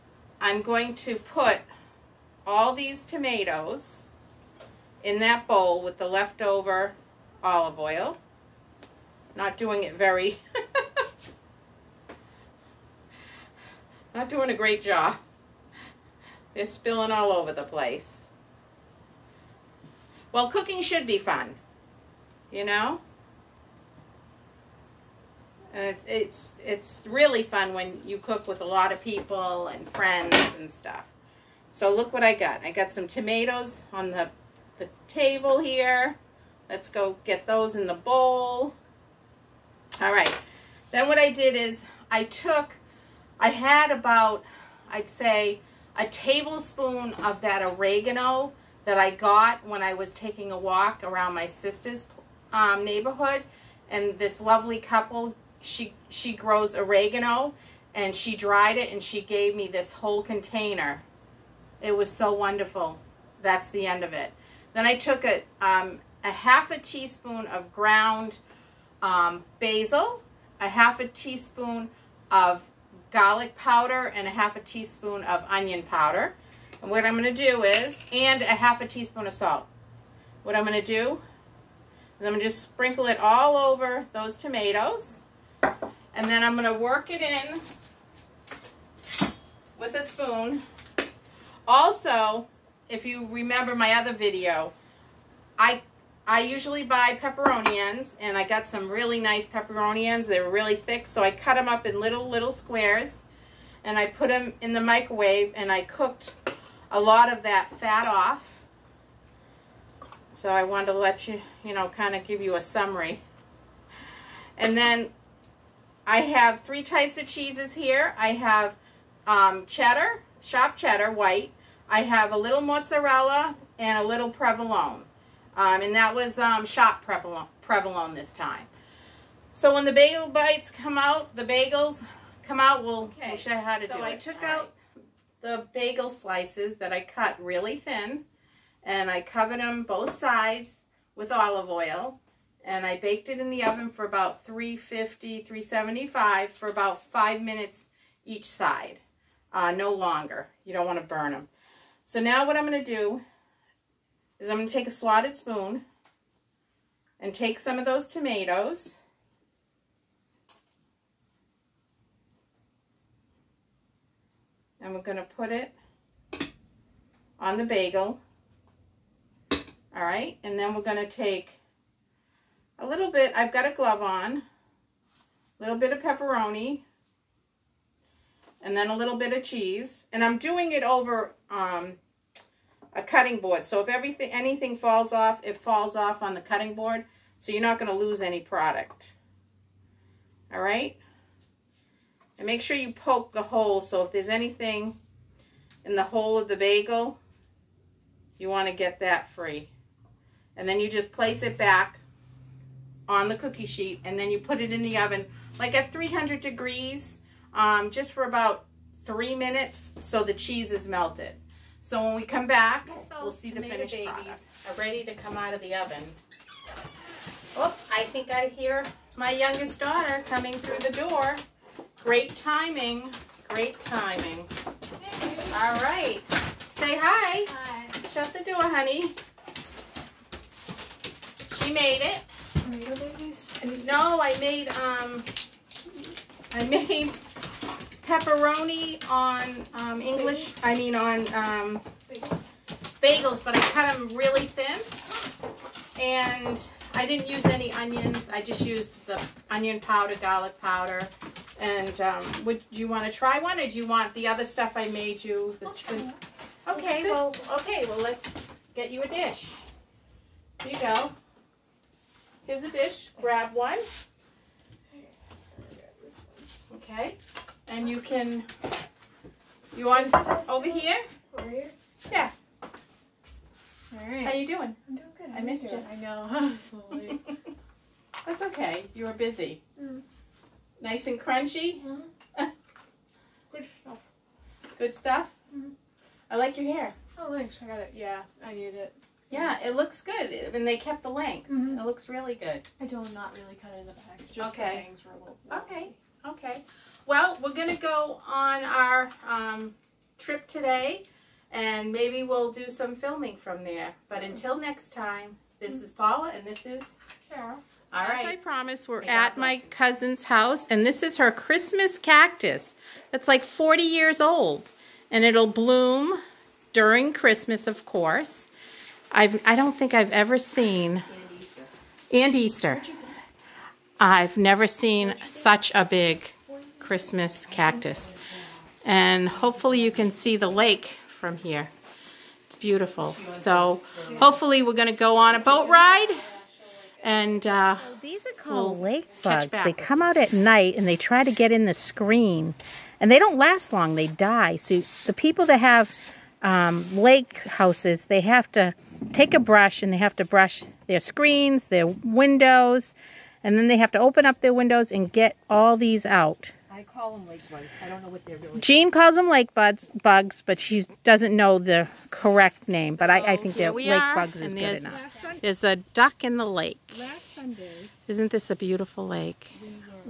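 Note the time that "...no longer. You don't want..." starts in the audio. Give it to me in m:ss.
2:29.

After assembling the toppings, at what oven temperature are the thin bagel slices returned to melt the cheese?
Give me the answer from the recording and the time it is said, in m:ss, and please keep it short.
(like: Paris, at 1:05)
300 degrees, at 3:25.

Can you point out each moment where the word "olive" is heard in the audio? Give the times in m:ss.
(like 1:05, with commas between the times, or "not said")
0:07, 2:21.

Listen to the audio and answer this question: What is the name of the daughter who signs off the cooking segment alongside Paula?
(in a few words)
Carol.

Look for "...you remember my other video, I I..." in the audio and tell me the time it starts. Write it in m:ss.
1:33.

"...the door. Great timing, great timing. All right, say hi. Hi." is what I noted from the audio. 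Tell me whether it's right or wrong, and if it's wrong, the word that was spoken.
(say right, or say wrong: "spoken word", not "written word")
right.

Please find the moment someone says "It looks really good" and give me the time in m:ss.
4:51.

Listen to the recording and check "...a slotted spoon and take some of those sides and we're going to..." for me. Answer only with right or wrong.
wrong.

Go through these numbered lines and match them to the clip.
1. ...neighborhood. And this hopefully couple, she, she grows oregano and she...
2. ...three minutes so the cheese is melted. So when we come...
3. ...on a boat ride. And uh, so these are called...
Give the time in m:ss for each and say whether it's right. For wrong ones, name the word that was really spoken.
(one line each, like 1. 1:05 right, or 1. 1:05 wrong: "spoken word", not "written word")
1. 0:52 wrong: "lovely", not "hopefully"
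2. 3:29 right
3. 5:35 right.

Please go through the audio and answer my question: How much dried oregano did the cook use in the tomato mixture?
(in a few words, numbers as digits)
a tablespoon.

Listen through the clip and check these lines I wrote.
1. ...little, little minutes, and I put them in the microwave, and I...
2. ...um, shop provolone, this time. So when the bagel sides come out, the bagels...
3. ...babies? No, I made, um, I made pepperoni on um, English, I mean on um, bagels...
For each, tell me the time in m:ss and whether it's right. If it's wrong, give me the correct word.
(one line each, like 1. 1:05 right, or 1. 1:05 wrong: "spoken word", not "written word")
1. 1:42 wrong: "squares", not "minutes"
2. 2:06 wrong: "bites", not "sides"
3. 3:52 right.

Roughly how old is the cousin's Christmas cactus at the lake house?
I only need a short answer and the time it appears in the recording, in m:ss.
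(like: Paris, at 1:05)
40 years, at 5:13.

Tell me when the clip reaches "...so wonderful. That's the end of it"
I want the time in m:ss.
1:02.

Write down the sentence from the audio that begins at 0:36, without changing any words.
Let's go get those in the bowl.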